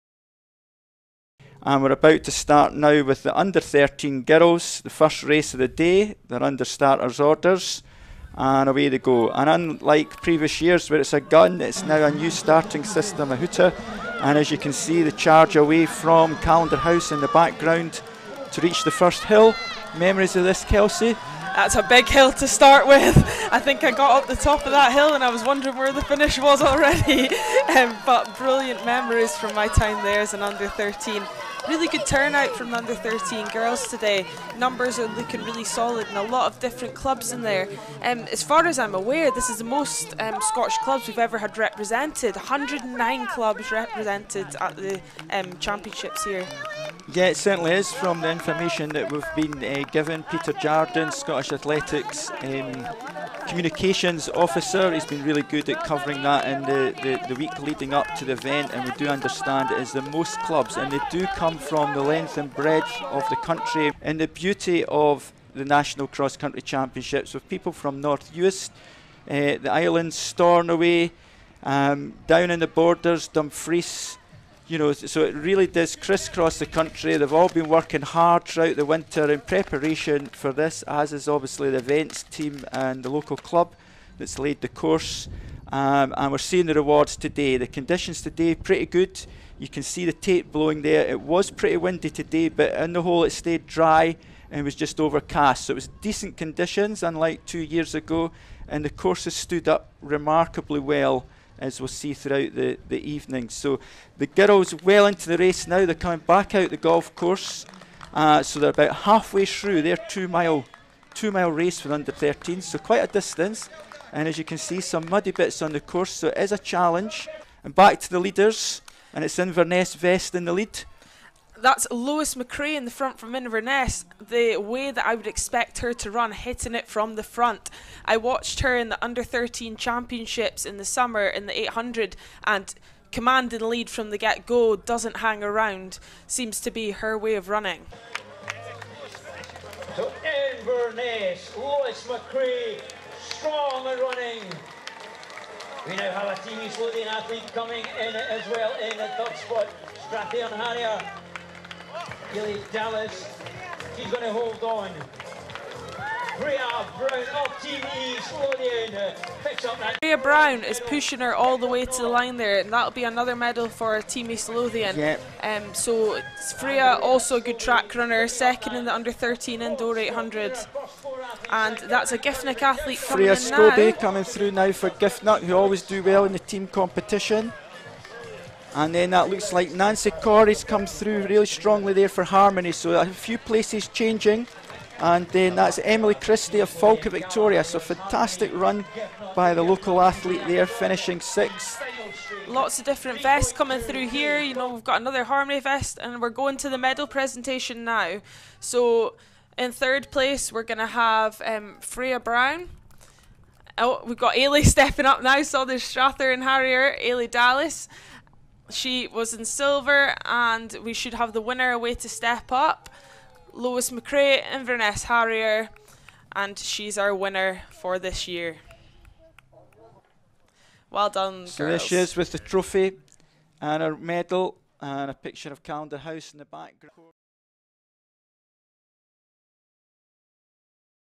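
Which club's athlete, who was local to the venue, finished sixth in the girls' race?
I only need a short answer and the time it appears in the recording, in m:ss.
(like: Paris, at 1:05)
Falkirk Victoria, at 3:06.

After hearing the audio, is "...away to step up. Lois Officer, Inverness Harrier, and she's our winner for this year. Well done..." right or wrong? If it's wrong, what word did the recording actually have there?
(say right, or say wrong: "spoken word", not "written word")
wrong: "McRae", not "Officer".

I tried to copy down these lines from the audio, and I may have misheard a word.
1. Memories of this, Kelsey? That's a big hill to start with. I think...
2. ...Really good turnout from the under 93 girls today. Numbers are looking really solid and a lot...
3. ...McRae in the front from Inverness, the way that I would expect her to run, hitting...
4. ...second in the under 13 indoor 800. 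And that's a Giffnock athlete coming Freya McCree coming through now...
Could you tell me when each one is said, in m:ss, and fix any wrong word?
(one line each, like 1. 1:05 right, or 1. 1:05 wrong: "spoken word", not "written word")
1. 0:19 right
2. 0:31 wrong: "13", not "93"
3. 2:02 right
4. 2:48 wrong: "Scobie", not "McCree".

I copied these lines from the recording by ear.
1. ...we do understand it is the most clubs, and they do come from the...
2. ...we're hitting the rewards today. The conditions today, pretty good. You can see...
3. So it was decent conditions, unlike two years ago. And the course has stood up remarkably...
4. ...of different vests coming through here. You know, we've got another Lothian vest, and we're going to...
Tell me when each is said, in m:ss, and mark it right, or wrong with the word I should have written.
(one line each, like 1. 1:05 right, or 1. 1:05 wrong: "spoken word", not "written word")
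1. 0:58 right
2. 1:26 wrong: "seeing", not "hitting"
3. 1:35 right
4. 3:12 wrong: "Harmeny", not "Lothian".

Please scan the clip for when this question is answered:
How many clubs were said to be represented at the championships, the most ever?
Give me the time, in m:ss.
0:42.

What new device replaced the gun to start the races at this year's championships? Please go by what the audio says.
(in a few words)
A hooter.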